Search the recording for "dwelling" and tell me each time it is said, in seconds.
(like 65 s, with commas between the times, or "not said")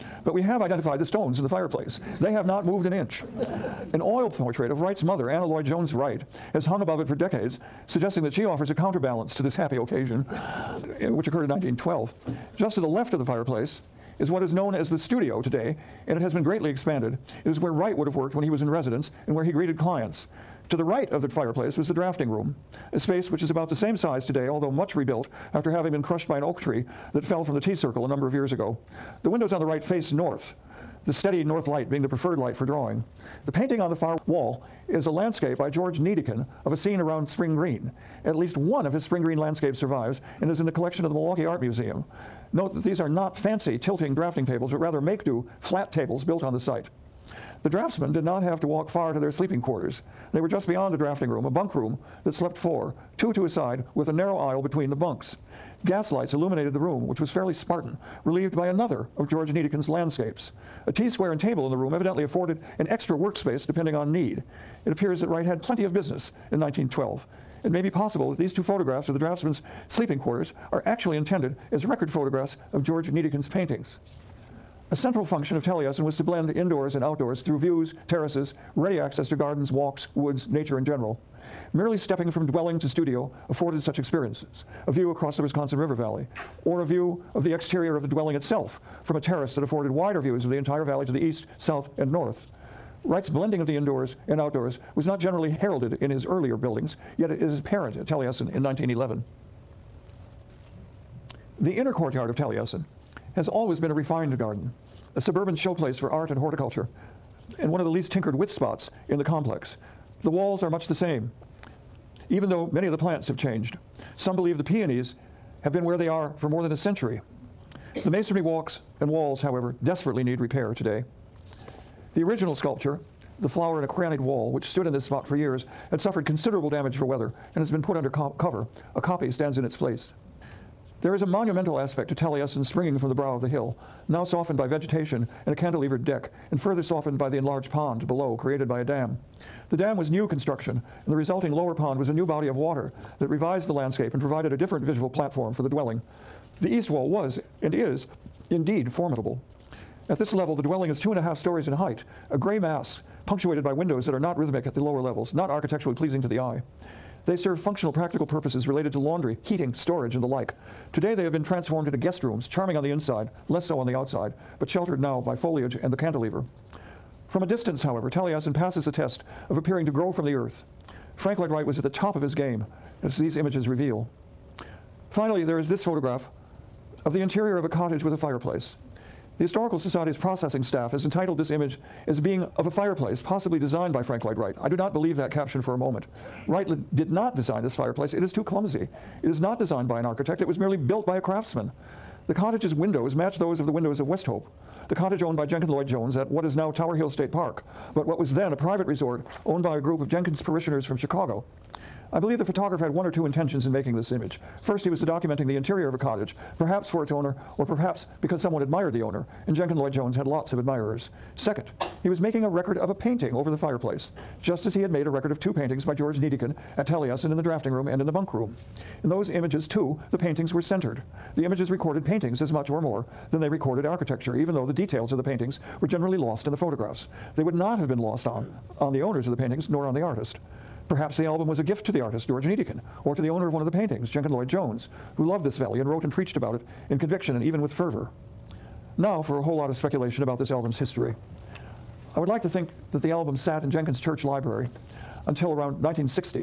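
82 s, 88 s, 145 s, 150 s.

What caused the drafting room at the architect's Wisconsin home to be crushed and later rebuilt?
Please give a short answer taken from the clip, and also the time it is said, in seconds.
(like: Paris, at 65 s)
An oak tree, at 26 s.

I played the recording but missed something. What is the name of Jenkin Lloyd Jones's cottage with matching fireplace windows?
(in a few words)
Westhope.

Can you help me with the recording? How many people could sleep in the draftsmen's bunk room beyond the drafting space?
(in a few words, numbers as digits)
4.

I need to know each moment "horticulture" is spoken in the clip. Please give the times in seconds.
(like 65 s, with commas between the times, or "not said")
106 s.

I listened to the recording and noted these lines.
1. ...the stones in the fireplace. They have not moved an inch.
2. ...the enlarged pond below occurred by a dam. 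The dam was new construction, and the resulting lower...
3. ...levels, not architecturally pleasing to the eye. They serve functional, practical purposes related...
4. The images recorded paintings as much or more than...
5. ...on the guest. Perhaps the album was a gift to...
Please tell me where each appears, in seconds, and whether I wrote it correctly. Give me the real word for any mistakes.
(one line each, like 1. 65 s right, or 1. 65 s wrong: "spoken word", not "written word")
1. 0 s right
2. 137 s wrong: "created", not "occurred"
3. 155 s right
4. 221 s right
5. 229 s wrong: "artist", not "guest".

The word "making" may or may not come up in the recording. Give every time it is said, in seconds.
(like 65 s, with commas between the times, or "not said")
203 s, 212 s.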